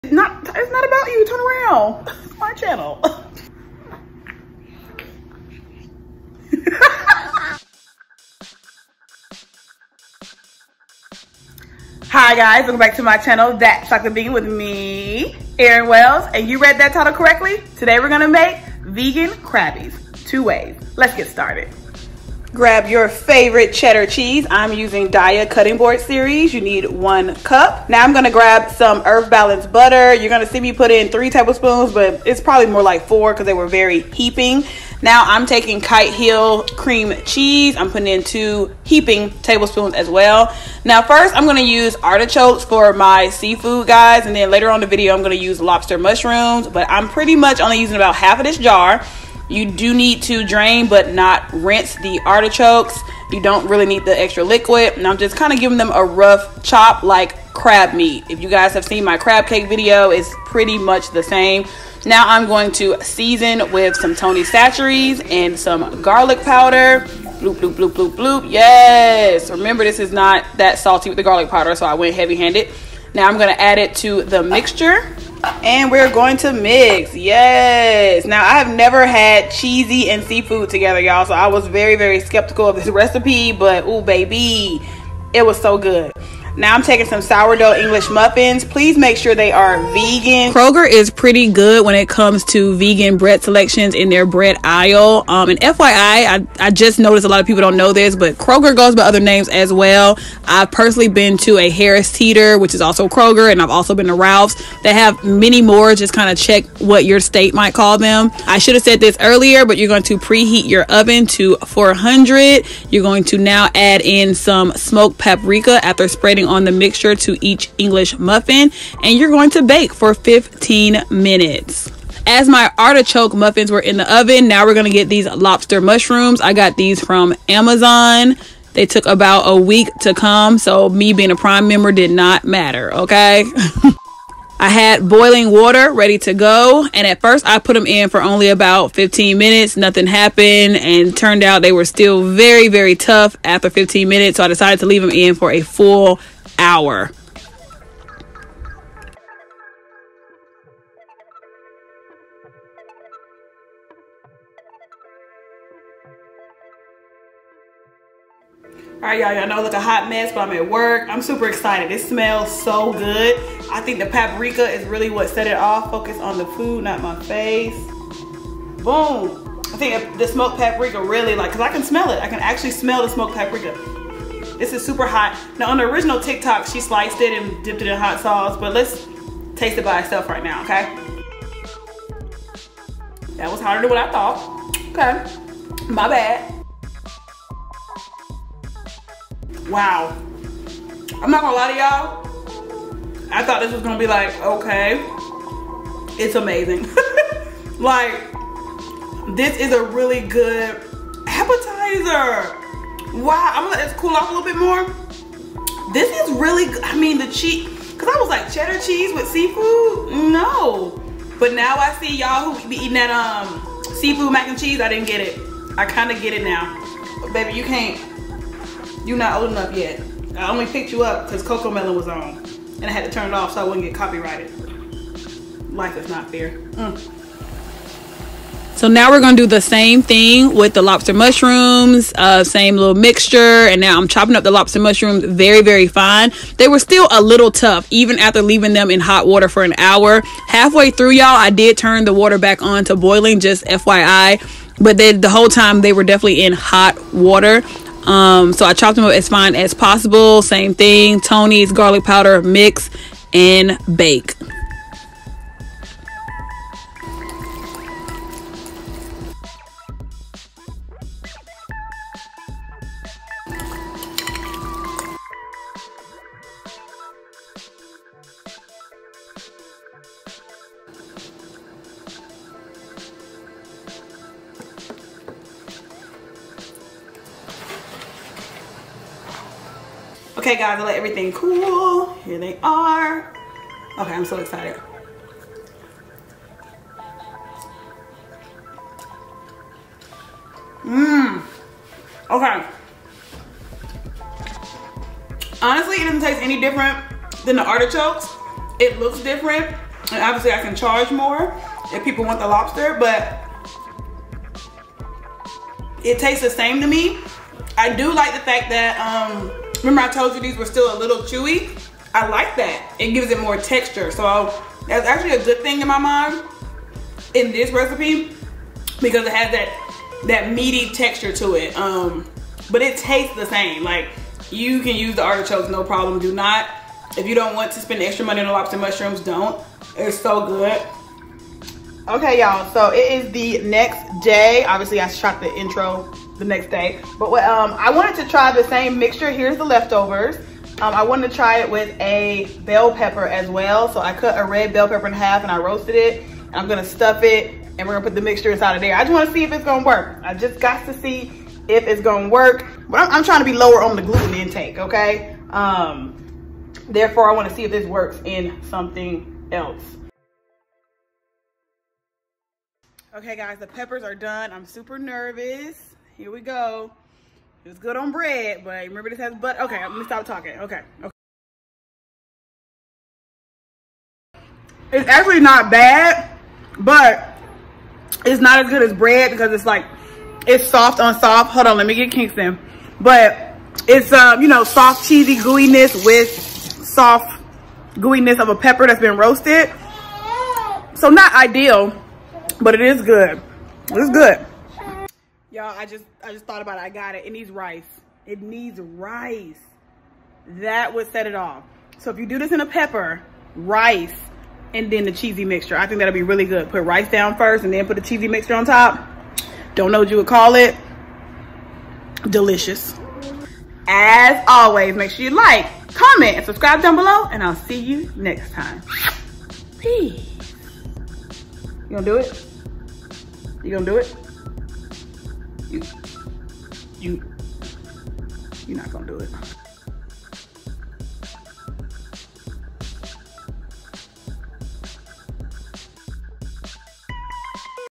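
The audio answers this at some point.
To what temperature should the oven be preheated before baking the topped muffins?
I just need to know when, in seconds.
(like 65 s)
111 s.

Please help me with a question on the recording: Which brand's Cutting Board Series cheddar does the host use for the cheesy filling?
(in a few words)
Daiya.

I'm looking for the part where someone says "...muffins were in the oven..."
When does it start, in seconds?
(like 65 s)
123 s.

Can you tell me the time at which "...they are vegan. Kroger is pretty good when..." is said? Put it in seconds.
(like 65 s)
89 s.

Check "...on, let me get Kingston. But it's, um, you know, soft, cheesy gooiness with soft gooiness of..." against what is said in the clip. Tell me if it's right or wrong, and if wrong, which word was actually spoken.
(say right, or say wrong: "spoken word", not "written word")
right.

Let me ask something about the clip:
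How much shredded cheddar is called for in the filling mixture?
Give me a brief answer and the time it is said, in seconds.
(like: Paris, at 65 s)
1 cup, at 26 s.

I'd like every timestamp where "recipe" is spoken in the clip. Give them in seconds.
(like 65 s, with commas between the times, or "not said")
82 s, 317 s.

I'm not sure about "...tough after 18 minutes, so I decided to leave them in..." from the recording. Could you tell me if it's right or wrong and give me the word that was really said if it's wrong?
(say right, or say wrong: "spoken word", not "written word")
wrong: "15", not "18".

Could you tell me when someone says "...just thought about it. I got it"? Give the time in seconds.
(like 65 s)
396 s.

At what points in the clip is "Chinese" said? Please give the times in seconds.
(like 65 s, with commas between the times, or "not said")
not said.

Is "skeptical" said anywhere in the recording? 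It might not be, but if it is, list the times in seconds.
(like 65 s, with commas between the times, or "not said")
82 s.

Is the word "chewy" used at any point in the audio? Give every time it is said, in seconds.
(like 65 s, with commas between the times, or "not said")
311 s.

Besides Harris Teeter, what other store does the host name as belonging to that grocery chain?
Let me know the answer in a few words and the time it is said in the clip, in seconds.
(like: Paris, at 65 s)
Ralph's, at 104 s.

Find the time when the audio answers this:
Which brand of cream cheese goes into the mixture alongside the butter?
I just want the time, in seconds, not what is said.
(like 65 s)
35 s.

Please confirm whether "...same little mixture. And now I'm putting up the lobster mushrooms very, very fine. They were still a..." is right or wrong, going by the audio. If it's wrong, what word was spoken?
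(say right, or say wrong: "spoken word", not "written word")
wrong: "chopping", not "putting".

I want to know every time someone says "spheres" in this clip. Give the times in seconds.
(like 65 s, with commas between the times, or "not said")
not said.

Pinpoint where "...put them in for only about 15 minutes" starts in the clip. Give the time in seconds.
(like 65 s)
137 s.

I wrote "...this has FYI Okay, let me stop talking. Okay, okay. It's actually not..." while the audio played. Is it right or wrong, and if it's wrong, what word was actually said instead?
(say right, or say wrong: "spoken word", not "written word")
wrong: "But", not "FYI".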